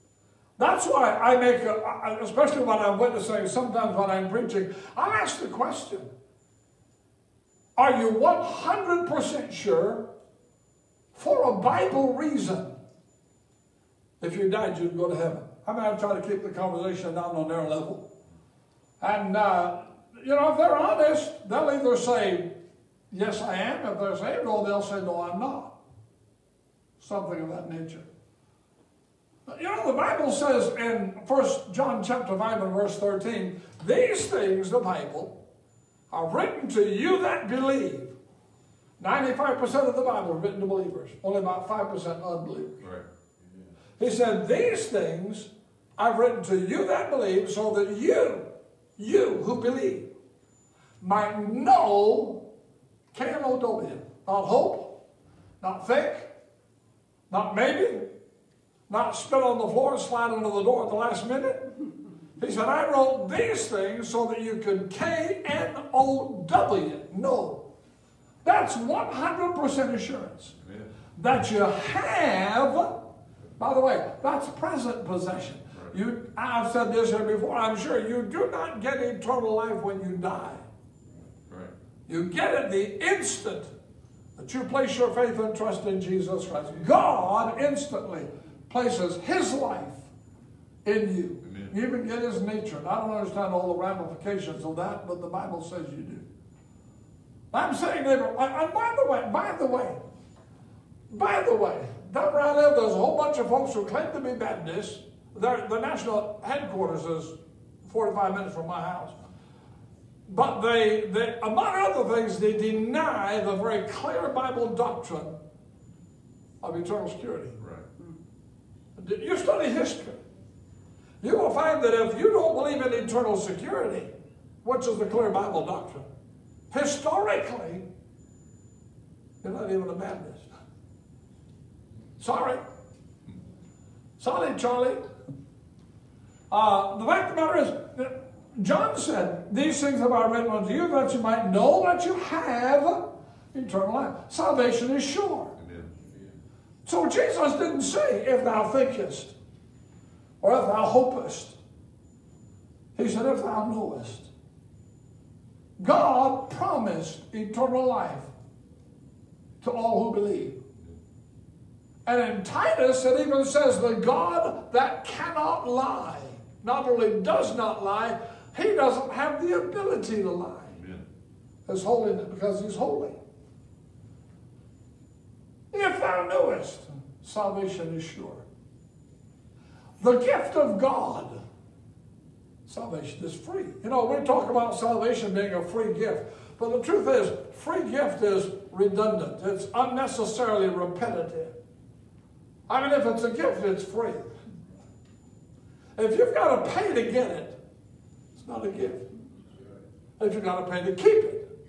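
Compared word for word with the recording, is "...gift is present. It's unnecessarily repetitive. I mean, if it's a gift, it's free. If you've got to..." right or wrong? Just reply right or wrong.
wrong.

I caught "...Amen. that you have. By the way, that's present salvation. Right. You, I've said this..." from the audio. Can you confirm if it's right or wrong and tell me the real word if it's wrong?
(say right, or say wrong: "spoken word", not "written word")
wrong: "possession", not "salvation".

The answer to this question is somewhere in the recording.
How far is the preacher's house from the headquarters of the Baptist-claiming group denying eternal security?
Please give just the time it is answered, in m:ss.
1:47.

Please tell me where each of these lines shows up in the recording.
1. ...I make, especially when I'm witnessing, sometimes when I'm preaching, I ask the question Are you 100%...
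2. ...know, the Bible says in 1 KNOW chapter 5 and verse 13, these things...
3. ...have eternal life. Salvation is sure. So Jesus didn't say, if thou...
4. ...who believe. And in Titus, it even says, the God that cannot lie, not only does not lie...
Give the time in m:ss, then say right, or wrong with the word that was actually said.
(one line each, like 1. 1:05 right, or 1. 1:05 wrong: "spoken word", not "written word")
1. 0:01 right
2. 0:29 wrong: "John", not "KNOW"
3. 2:22 right
4. 2:40 right.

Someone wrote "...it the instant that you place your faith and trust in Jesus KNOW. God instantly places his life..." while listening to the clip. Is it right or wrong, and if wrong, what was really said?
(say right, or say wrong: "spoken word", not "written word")
wrong: "Christ", not "KNOW".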